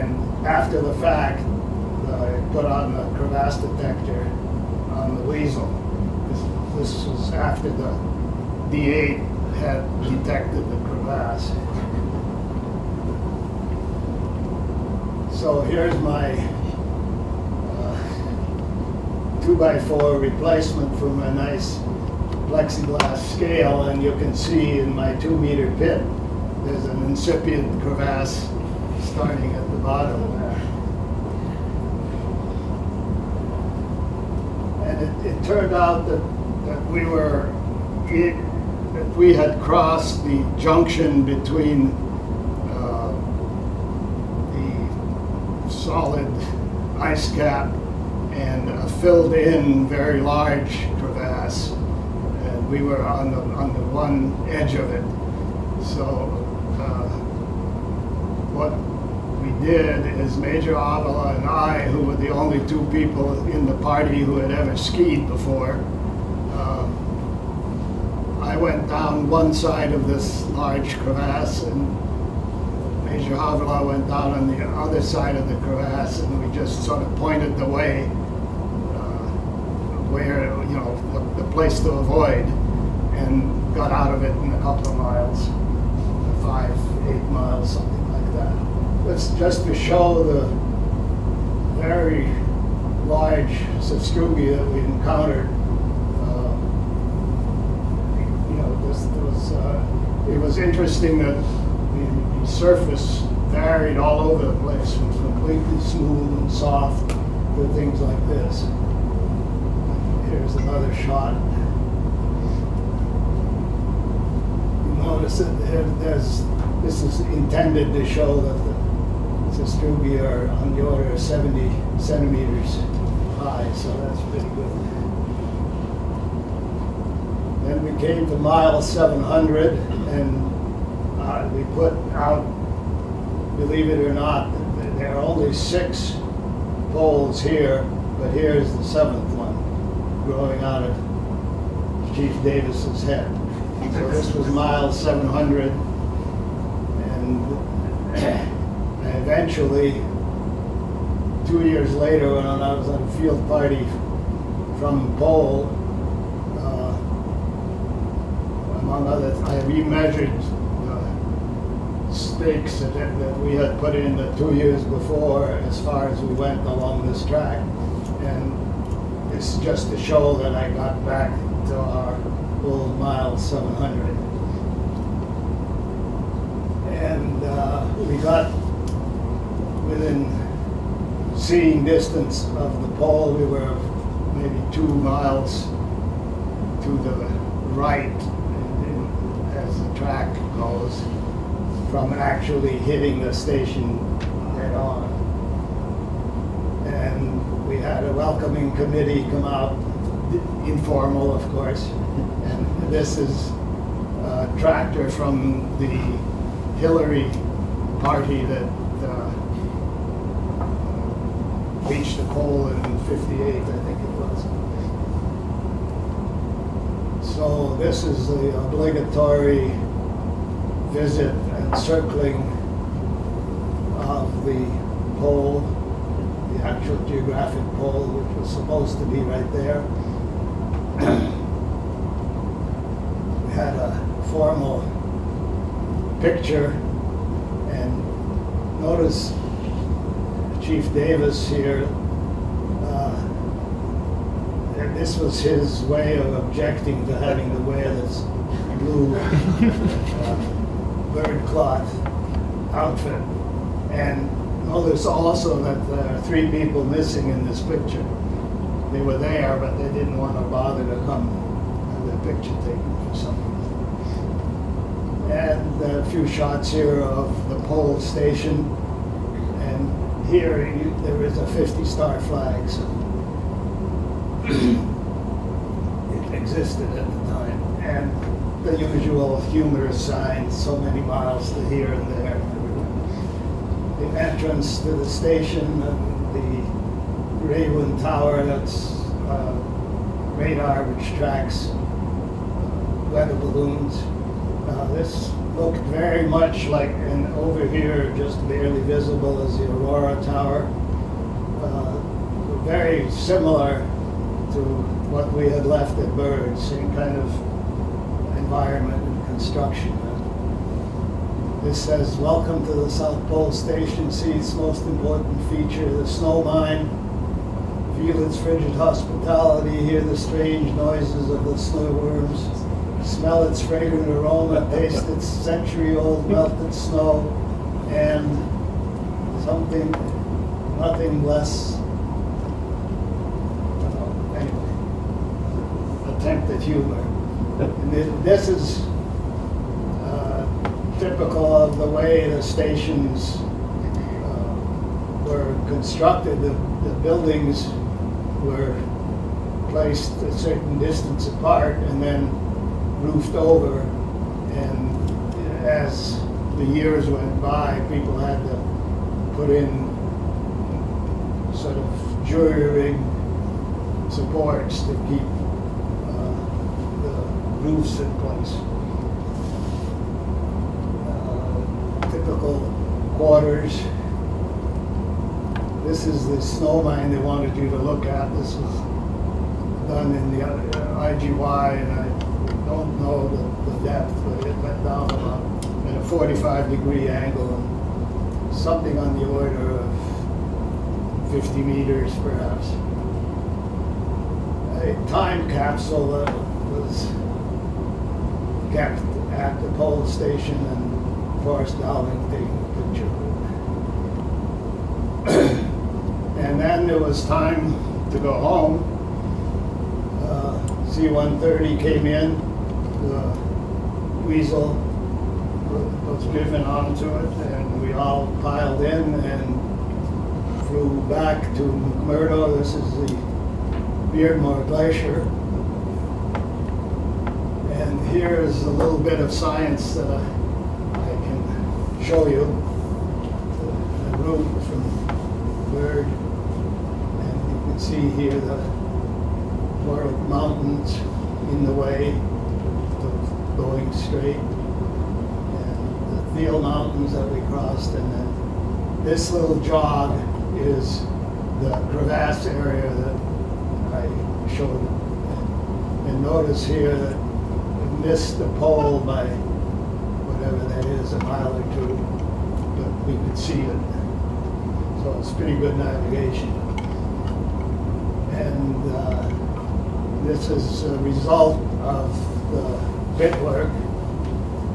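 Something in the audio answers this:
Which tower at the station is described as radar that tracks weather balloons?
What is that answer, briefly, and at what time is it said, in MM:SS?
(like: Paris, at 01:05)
Rawin Tower, at 04:47.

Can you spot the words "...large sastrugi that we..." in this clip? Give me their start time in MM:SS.
01:33.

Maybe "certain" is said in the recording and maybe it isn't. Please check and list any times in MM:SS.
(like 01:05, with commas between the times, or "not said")
05:50.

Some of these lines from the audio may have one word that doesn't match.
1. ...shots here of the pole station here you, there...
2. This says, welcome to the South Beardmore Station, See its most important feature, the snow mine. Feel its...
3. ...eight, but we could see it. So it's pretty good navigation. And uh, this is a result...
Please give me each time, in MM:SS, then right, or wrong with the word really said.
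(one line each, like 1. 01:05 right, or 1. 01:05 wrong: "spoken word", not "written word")
1. 04:26 right
2. 05:11 wrong: "Pole", not "Beardmore"
3. 07:41 wrong: "two", not "eight".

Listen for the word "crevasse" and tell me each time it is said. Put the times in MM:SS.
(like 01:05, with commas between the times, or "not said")
00:03, 00:10, 00:27, 00:50, 01:10, 01:15, 07:31.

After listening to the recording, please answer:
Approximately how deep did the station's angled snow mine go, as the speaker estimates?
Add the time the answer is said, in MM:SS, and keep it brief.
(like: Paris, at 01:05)
50 meters, at 06:31.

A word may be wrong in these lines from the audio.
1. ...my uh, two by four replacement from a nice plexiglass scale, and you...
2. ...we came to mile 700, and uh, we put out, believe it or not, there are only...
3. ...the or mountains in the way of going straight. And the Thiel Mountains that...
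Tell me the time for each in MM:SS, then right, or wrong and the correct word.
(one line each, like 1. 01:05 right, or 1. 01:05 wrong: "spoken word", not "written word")
1. 00:15 right
2. 02:07 right
3. 07:18 right.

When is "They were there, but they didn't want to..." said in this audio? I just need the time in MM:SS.
04:18.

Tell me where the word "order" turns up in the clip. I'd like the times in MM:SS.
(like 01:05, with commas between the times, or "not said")
02:00, 06:29.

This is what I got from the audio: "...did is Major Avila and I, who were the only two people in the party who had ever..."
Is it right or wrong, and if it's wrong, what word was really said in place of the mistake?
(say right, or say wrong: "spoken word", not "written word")
right.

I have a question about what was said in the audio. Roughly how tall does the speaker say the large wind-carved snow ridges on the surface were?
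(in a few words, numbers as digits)
70 centimeters.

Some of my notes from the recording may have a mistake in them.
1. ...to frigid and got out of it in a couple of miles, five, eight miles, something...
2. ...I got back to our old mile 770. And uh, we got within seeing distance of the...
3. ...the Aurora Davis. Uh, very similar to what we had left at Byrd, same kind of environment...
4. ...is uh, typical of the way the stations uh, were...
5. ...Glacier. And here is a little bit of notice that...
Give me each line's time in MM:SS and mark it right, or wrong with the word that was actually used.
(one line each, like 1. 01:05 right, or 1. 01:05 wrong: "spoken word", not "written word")
1. 01:21 wrong: "avoid", not "frigid"
2. 02:50 wrong: "700", not "770"
3. 04:59 wrong: "Tower", not "Davis"
4. 05:38 right
5. 07:04 wrong: "science", not "notice".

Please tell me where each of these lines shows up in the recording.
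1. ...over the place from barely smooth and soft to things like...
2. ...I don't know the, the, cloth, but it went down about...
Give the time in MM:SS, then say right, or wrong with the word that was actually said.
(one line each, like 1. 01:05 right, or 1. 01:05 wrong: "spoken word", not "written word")
1. 01:44 wrong: "completely", not "barely"
2. 06:21 wrong: "depth", not "cloth".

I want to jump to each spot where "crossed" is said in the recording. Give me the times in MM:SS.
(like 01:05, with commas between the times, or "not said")
00:39, 07:27.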